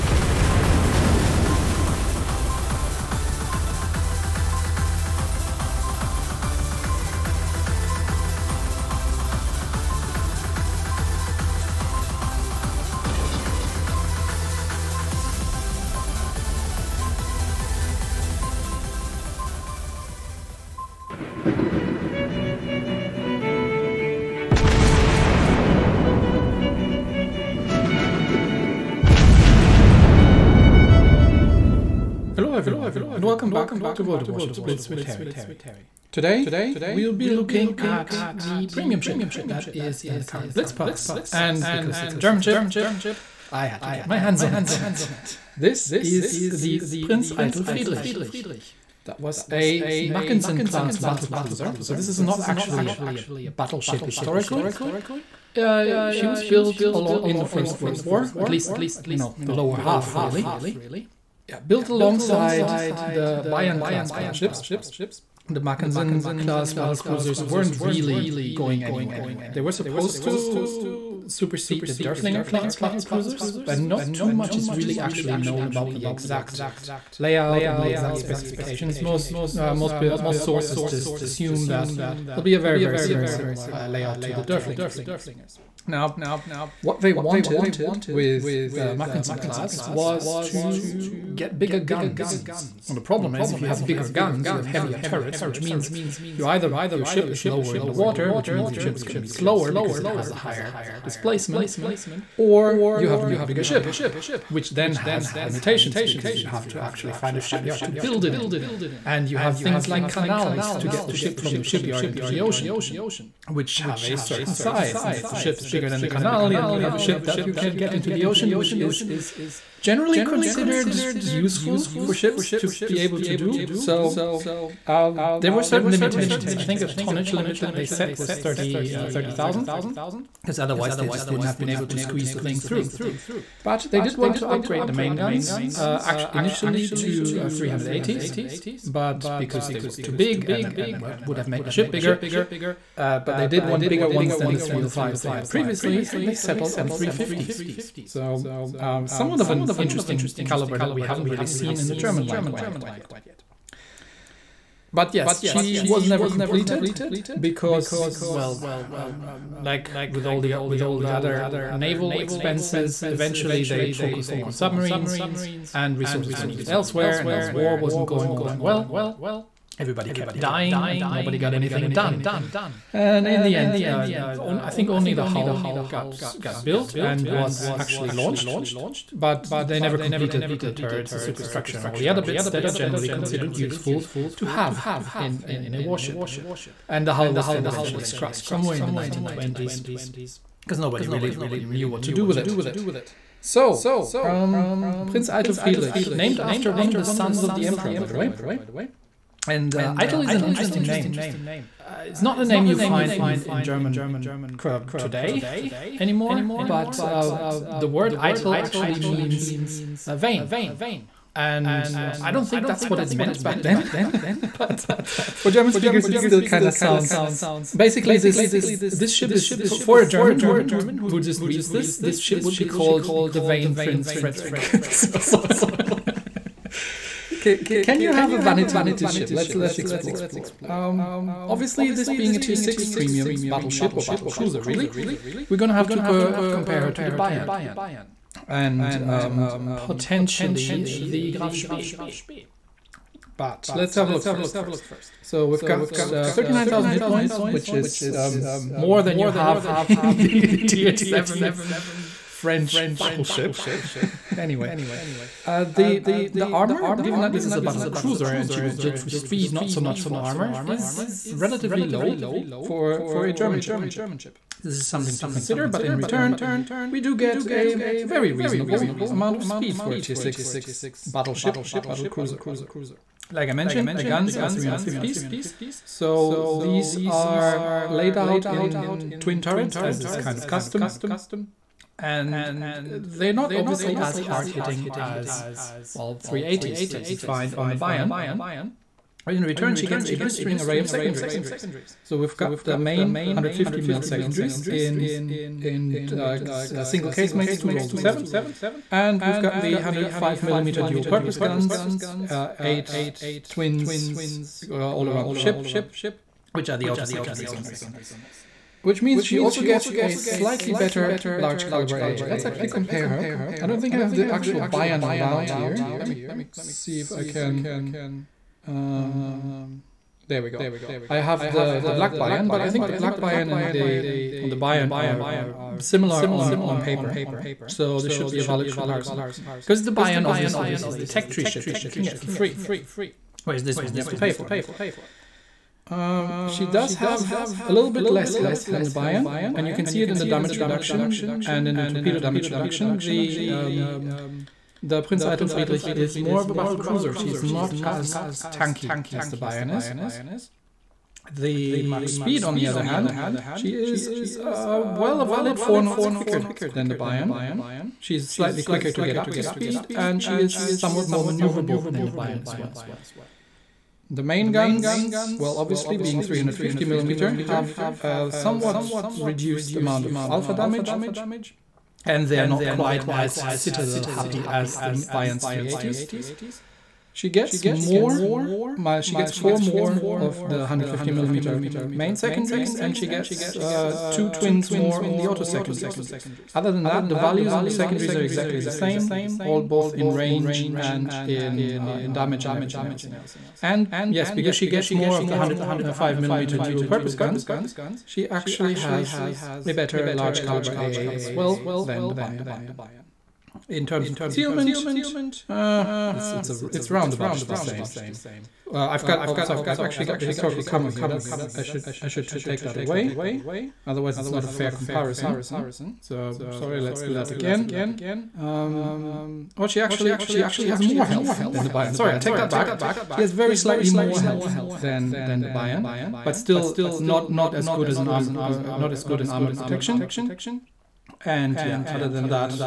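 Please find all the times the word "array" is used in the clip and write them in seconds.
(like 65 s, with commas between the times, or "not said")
290 s.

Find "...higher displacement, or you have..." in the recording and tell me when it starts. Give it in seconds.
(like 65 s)
100 s.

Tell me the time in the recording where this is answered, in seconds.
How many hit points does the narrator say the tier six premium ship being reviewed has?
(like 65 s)
246 s.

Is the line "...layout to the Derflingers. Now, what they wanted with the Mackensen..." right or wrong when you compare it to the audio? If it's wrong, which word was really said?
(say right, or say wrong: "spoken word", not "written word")
right.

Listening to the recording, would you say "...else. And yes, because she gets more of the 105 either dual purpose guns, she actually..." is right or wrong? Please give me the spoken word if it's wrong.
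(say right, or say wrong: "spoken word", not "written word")
wrong: "millimeter", not "either".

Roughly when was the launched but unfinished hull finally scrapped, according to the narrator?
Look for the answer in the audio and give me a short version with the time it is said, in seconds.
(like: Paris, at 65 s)
1920s, at 188 s.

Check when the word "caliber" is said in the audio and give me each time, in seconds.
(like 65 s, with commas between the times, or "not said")
150 s, 311 s, 400 s.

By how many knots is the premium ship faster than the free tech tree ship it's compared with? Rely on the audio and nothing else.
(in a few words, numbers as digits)
4.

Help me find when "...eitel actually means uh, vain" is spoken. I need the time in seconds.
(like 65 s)
208 s.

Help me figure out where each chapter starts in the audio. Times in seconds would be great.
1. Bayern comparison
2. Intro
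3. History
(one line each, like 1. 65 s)
1. 229 s
2. 20 s
3. 47 s.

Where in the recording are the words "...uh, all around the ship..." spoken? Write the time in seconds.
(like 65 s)
304 s.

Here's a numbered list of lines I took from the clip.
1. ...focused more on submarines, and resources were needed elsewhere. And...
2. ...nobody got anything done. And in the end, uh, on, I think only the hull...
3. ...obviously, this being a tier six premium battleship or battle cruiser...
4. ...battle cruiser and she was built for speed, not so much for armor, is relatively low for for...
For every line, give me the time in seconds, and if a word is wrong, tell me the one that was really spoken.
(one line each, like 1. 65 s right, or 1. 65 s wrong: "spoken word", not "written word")
1. 163 s right
2. 171 s right
3. 231 s right
4. 257 s right.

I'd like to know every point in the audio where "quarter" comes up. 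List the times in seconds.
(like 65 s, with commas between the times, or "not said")
not said.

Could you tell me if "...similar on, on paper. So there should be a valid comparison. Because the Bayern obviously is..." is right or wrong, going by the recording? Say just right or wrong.
right.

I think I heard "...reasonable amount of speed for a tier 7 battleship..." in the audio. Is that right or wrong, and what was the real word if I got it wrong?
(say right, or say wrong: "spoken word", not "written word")
wrong: "6", not "7".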